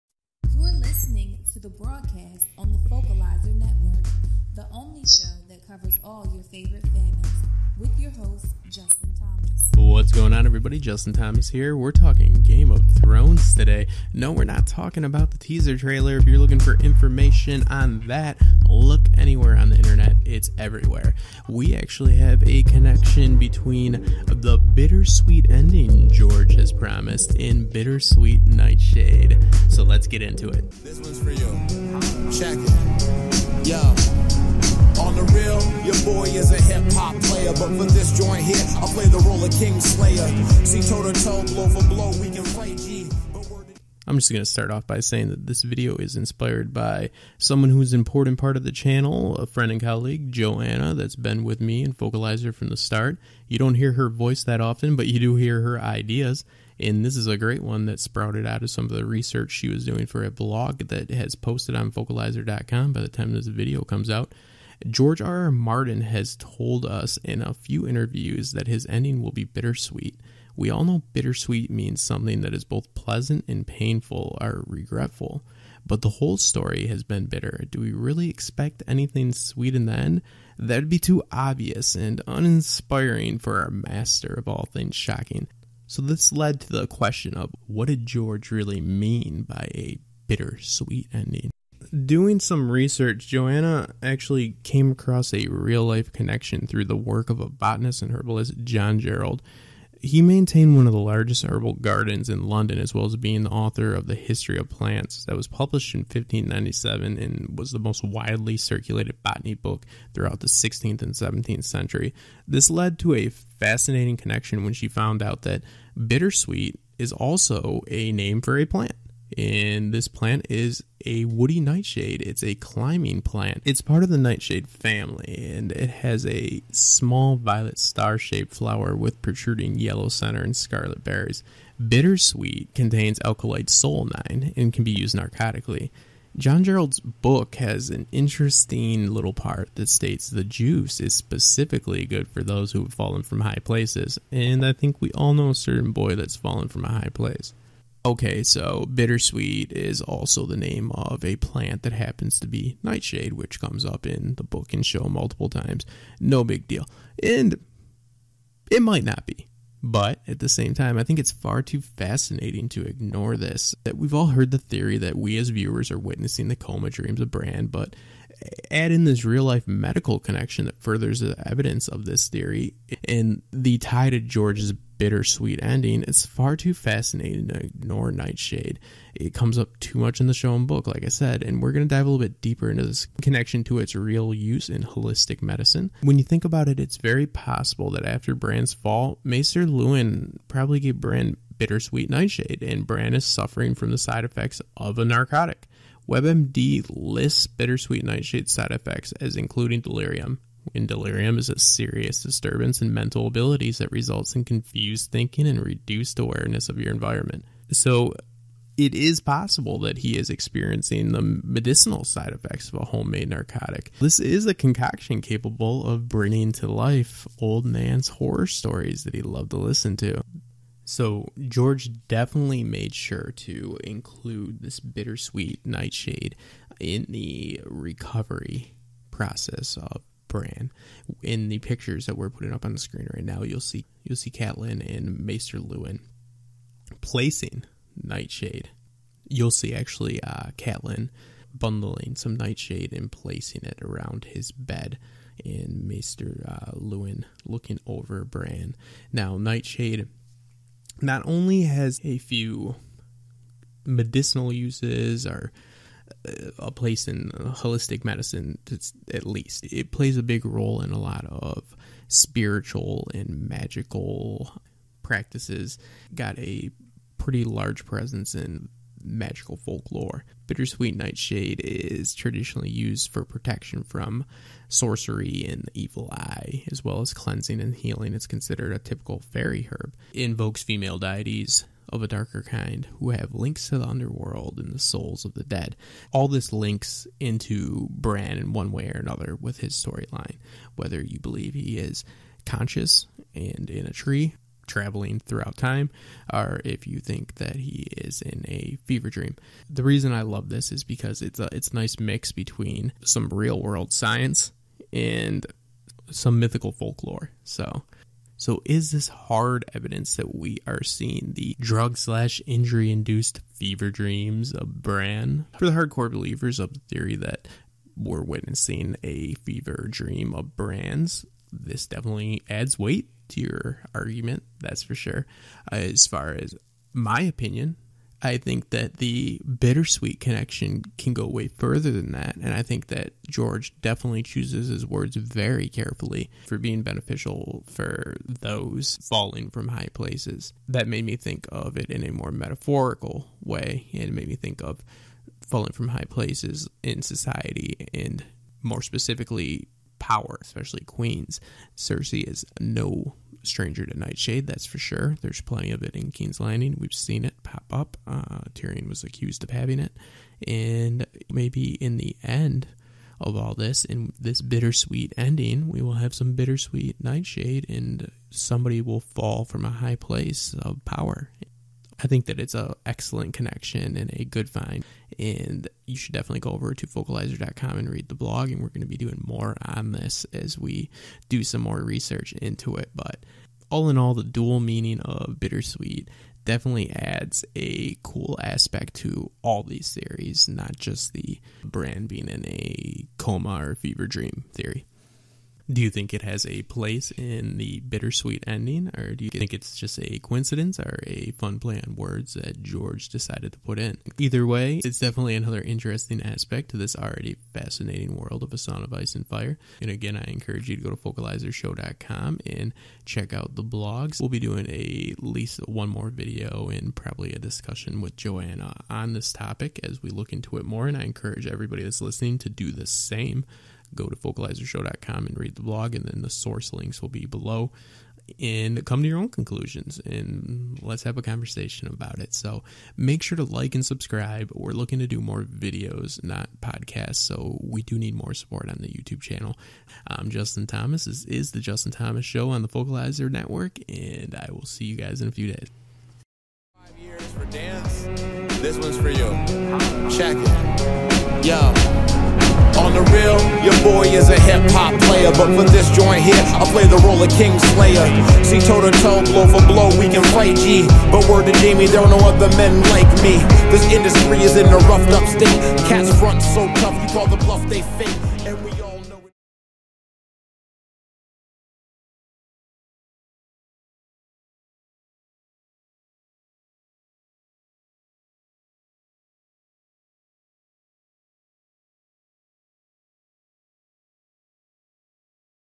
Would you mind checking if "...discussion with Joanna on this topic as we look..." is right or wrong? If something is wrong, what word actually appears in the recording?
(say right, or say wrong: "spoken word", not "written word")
right.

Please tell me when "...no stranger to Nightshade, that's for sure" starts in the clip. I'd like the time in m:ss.
5:52.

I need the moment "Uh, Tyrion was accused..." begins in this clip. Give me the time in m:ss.
5:58.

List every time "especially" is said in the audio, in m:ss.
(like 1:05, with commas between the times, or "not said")
5:50.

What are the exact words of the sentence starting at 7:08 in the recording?
And come to your own conclusions and let's have a conversation about it.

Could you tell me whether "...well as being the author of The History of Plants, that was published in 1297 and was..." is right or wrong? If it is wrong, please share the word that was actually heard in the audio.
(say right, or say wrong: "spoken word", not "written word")
wrong: "1597", not "1297".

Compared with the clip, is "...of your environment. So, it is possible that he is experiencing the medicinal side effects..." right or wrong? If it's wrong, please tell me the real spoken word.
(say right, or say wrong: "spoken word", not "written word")
right.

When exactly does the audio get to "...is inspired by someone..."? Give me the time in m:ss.
0:45.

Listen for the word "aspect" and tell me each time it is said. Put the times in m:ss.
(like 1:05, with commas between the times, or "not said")
6:28, 6:46.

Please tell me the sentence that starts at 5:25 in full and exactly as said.
Uh, as far as my opinion, I think that the bittersweet connection can go way further than that.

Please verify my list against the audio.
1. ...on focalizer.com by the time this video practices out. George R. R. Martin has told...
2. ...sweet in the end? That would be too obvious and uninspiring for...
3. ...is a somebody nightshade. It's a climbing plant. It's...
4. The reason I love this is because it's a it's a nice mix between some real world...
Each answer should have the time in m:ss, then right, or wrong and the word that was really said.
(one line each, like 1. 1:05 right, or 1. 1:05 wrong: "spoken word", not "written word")
1. 1:01 wrong: "comes", not "practices"
2. 1:19 right
3. 2:00 wrong: "woody", not "somebody"
4. 4:59 right.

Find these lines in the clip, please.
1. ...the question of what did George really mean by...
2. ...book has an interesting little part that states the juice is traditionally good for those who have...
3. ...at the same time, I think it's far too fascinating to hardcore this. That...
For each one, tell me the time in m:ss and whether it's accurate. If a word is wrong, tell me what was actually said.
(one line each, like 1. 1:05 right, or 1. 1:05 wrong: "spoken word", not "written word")
1. 1:26 right
2. 2:16 wrong: "specifically", not "traditionally"
3. 2:40 wrong: "ignore", not "hardcore".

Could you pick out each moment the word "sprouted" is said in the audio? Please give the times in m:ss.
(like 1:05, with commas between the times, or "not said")
0:57.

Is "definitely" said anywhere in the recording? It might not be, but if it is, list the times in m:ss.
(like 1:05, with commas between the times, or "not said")
3:42, 5:21, 5:33, 6:16, 6:26, 6:44.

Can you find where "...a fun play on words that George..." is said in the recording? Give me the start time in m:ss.
6:41.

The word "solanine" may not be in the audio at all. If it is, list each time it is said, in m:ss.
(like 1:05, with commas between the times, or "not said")
2:13.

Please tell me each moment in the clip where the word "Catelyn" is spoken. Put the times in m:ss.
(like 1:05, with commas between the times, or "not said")
3:54, 4:00.